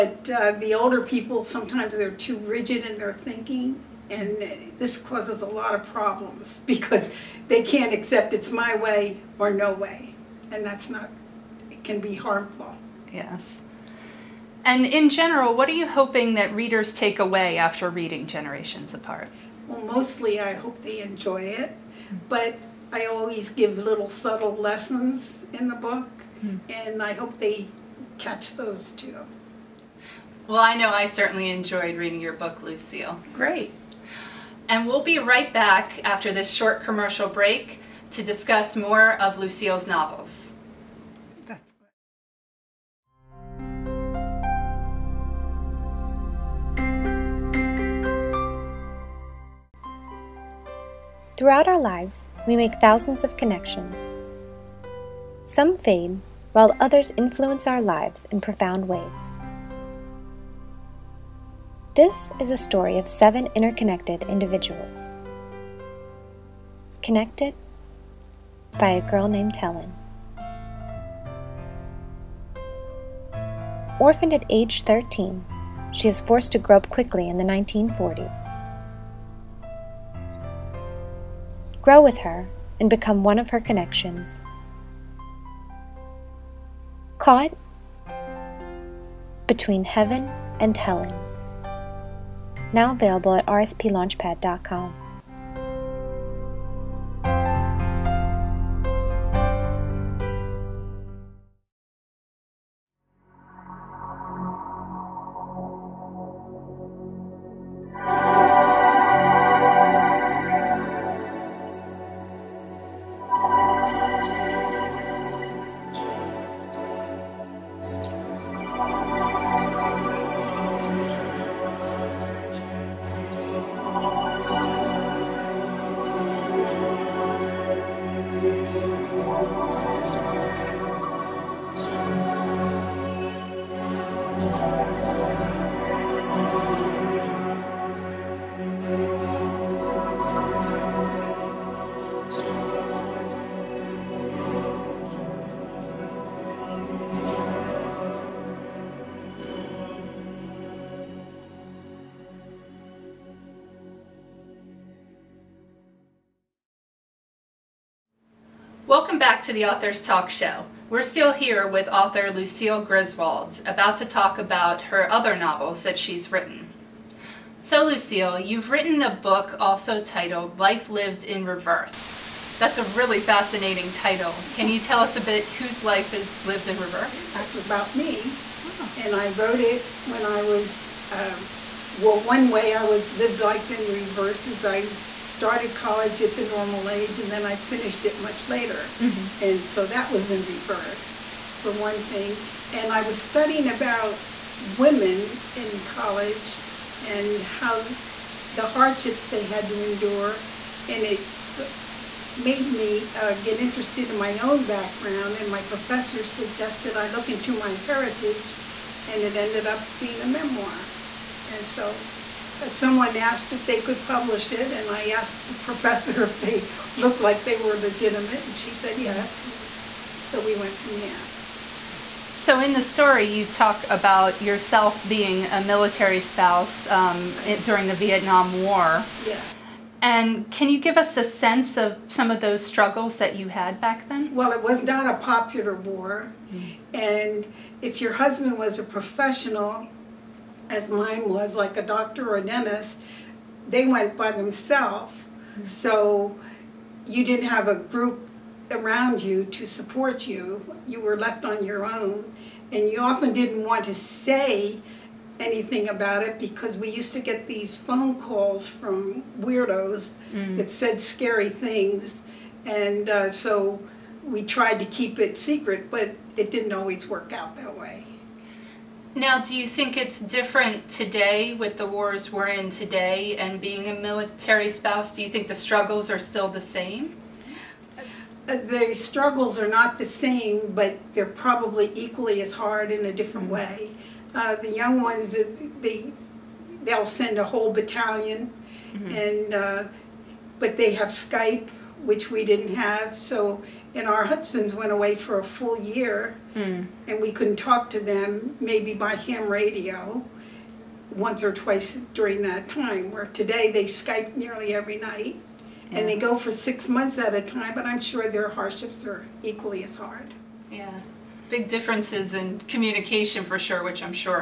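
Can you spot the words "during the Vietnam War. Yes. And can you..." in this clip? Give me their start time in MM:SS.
03:47.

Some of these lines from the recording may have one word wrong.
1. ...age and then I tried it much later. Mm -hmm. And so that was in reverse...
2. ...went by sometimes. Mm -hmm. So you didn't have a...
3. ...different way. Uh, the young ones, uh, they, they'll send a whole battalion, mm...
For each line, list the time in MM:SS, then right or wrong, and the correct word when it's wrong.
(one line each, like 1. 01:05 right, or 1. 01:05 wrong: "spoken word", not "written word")
1. 03:06 wrong: "finished", not "tried"
2. 04:03 wrong: "themselves", not "sometimes"
3. 04:43 right.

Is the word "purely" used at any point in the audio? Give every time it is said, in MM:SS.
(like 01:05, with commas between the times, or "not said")
not said.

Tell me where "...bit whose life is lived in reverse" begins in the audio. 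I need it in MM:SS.
02:55.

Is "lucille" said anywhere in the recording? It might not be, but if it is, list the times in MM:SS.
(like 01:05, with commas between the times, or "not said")
00:32, 00:39, 02:42, 02:47.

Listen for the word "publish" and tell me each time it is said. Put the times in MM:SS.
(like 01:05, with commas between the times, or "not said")
03:34.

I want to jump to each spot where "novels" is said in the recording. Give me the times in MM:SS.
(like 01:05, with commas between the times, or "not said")
00:39, 02:45.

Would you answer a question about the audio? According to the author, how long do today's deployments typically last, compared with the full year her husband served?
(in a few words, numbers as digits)
6 months.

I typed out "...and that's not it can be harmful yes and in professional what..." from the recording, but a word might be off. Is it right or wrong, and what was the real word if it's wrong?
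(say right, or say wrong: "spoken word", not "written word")
wrong: "general", not "professional".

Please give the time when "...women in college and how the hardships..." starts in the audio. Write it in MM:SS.
03:14.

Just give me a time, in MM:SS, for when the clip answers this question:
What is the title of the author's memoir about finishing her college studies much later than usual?
02:50.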